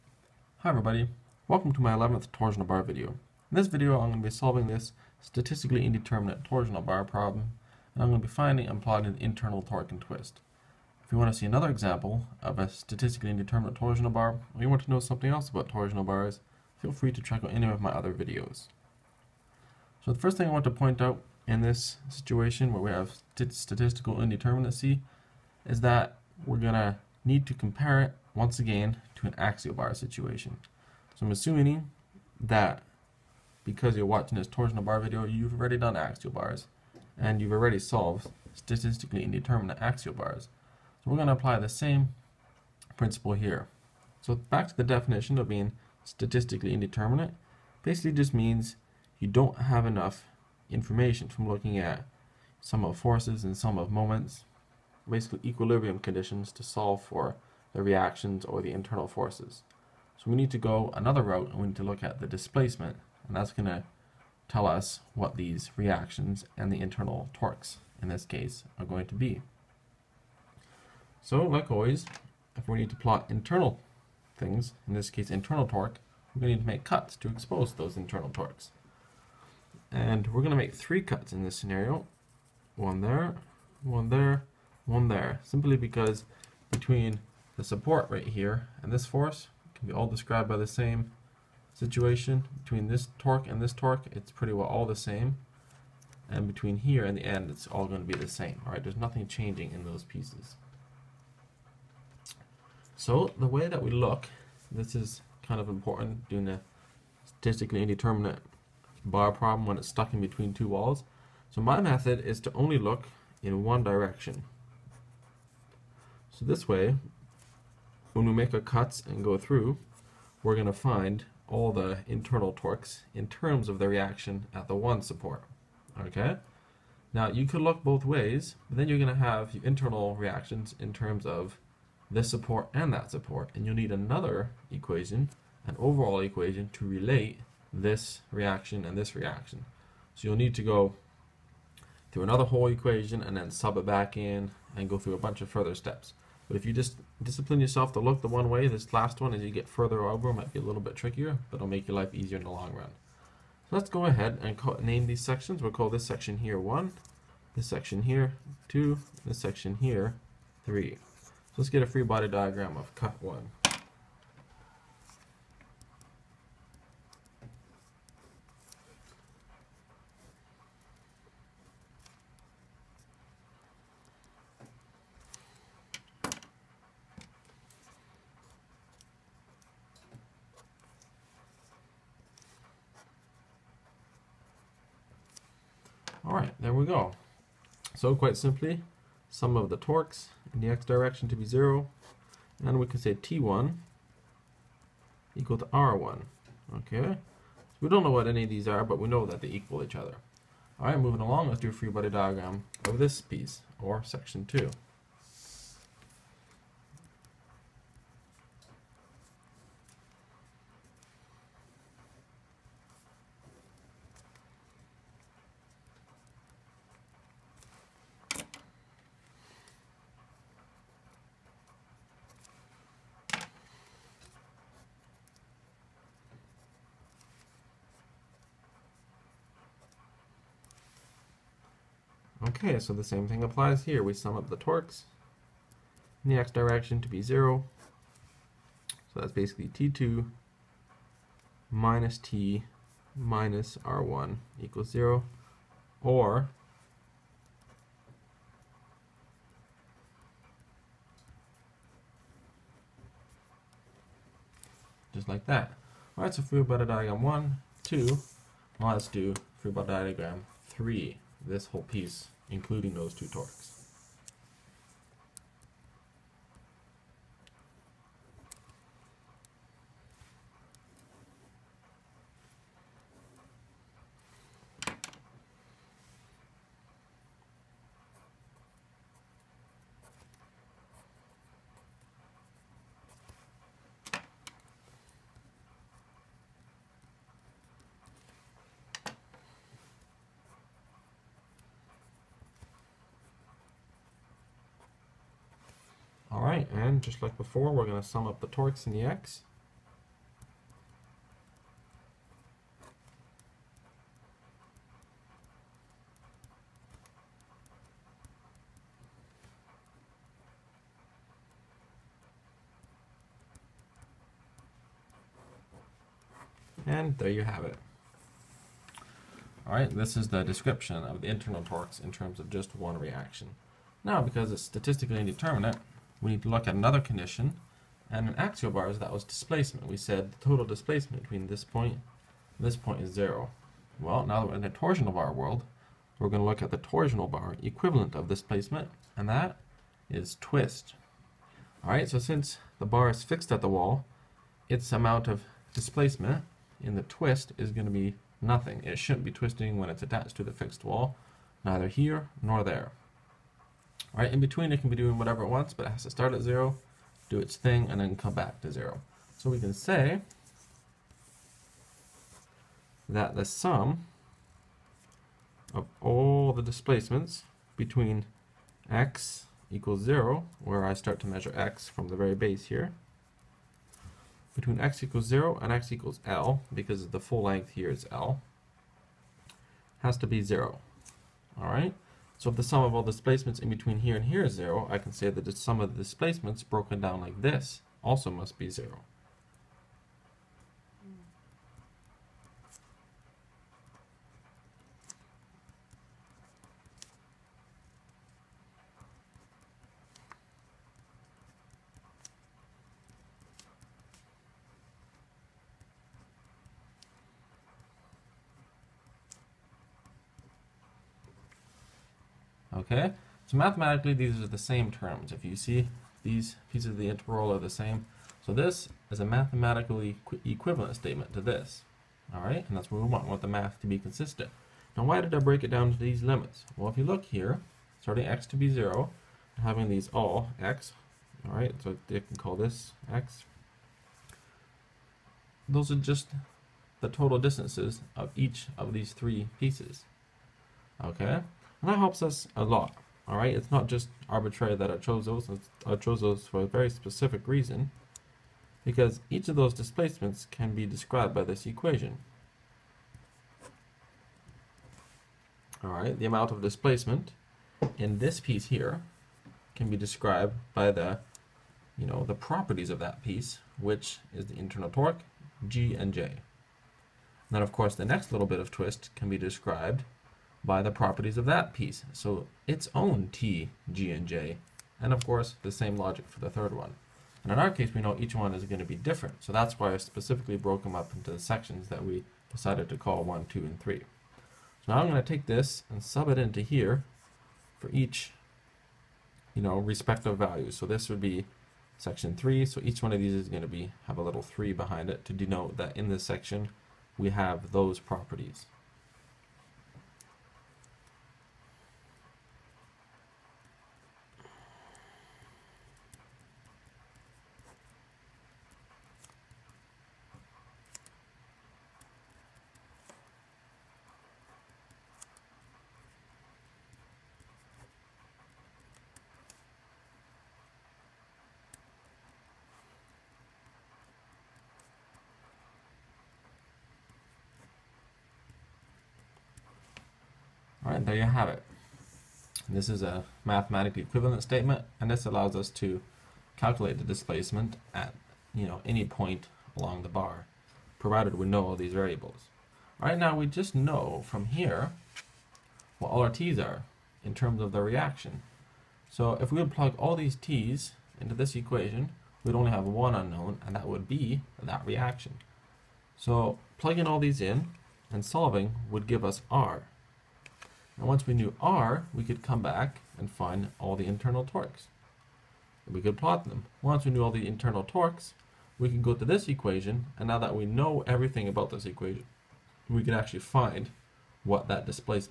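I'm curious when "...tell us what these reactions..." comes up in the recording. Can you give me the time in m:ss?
1:04.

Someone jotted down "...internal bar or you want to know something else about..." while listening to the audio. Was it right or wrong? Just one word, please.
wrong.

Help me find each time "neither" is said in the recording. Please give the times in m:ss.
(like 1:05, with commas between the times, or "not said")
5:51.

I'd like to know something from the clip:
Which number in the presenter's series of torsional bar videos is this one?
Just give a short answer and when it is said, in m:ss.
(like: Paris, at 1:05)
11th, at 0:01.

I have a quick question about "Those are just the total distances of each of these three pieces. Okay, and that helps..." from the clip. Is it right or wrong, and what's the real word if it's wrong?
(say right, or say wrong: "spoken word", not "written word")
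right.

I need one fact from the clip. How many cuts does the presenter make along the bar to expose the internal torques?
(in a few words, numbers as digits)
3.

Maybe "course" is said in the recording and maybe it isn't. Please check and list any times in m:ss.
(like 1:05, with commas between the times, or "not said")
7:47, 7:55.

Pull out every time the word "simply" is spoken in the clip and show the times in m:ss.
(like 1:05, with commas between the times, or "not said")
1:25, 3:08.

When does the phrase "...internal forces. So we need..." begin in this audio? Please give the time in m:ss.
0:58.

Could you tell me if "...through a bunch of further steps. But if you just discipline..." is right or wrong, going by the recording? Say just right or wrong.
right.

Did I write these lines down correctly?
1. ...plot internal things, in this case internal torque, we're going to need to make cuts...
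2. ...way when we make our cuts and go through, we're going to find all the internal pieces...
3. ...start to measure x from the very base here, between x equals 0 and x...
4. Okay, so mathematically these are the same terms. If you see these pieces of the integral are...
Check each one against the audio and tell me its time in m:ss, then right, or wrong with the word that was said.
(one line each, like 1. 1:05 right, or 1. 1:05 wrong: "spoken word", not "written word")
1. 1:12 right
2. 1:56 wrong: "torques", not "pieces"
3. 6:10 right
4. 6:52 right.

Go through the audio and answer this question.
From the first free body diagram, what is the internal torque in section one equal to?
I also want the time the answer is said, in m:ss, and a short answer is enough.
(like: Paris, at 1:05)
R1, at 3:13.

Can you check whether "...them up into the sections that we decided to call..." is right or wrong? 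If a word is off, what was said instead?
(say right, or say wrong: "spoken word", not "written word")
right.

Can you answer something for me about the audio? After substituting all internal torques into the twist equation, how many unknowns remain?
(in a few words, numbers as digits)
1.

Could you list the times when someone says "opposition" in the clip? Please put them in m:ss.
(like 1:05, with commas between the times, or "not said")
not said.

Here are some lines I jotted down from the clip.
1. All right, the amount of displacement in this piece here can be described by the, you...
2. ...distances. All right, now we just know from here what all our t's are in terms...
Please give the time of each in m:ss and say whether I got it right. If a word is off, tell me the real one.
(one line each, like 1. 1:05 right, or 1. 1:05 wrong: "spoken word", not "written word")
1. 7:35 right
2. 9:01 wrong: "variables", not "distances".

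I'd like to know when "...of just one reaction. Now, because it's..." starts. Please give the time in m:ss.
5:22.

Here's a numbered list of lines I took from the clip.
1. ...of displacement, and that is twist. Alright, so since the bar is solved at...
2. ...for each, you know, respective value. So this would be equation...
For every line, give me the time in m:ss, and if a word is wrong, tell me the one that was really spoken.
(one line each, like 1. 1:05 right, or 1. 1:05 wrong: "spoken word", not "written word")
1. 5:38 wrong: "fixed", not "solved"
2. 8:07 wrong: "section", not "equation".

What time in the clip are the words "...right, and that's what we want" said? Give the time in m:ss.
7:02.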